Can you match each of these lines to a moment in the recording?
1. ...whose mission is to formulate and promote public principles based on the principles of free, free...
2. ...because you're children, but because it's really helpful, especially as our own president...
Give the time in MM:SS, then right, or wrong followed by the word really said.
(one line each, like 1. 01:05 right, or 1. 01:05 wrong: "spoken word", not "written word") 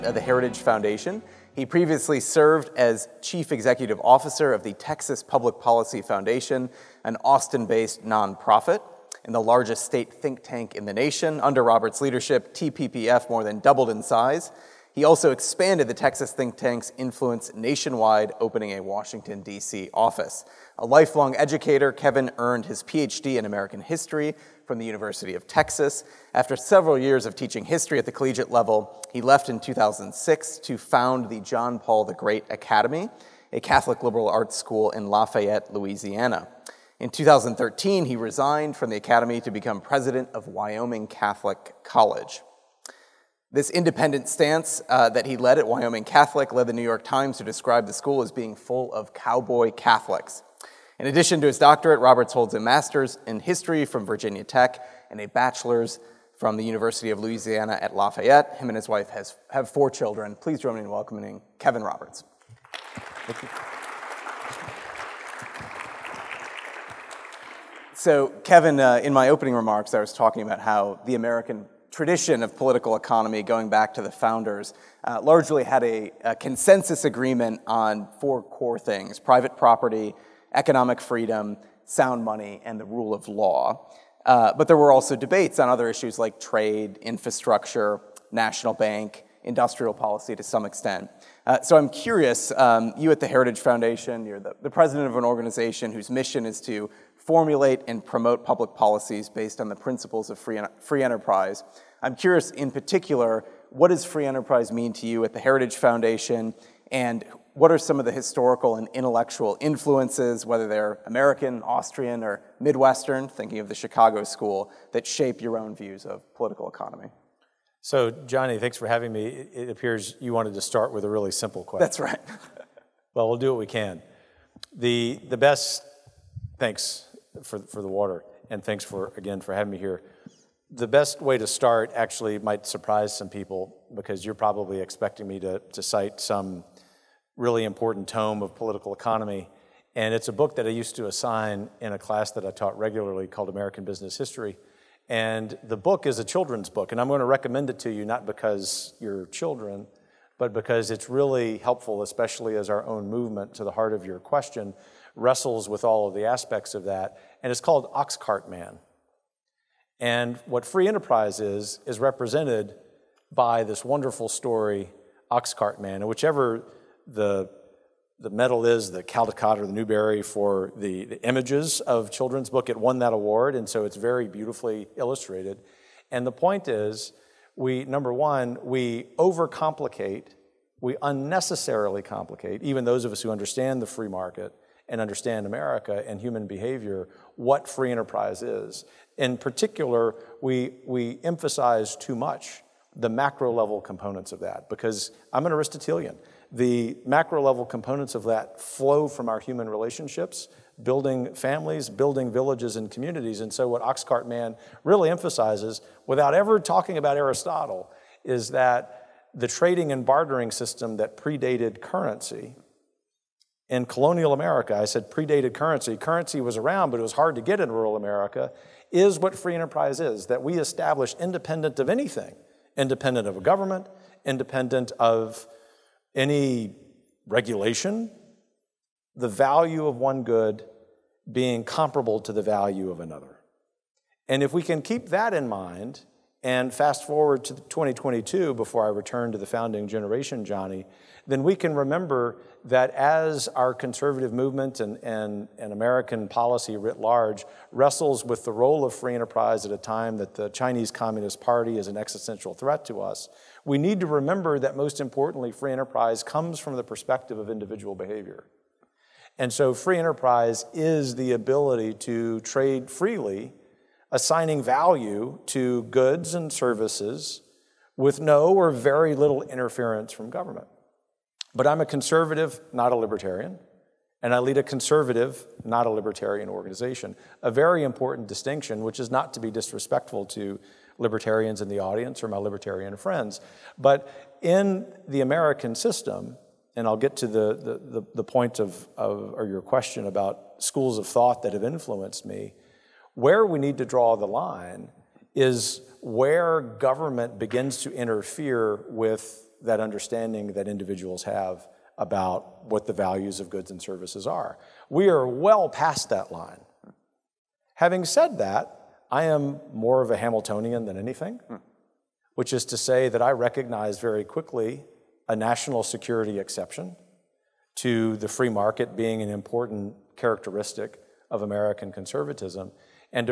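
1. 01:35 wrong: "policies", not "principles"
2. 02:28 wrong: "movement", not "president".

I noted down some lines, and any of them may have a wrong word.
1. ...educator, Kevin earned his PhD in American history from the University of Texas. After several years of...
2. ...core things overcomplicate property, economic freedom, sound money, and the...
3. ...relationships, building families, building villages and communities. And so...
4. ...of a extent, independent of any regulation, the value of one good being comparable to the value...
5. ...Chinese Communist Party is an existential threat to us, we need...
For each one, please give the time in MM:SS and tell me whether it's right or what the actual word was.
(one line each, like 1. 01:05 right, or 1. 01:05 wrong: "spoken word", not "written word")
1. 00:21 right
2. 01:18 wrong: "private", not "overcomplicate"
3. 03:19 right
4. 03:43 wrong: "government", not "extent"
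5. 04:10 right.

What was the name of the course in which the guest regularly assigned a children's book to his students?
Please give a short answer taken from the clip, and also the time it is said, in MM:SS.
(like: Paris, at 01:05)
American Business History, at 02:23.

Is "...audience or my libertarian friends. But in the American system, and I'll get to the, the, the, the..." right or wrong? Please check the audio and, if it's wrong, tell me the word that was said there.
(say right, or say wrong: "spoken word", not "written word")
right.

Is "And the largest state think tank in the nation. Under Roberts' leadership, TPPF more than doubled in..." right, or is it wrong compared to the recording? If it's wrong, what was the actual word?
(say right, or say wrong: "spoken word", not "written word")
right.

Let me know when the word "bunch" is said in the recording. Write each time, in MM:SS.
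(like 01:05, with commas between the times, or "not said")
not said.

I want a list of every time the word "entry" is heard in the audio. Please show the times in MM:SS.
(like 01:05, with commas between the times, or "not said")
not said.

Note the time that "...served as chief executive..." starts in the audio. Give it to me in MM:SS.
00:02.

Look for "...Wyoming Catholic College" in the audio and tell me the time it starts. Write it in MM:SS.
00:40.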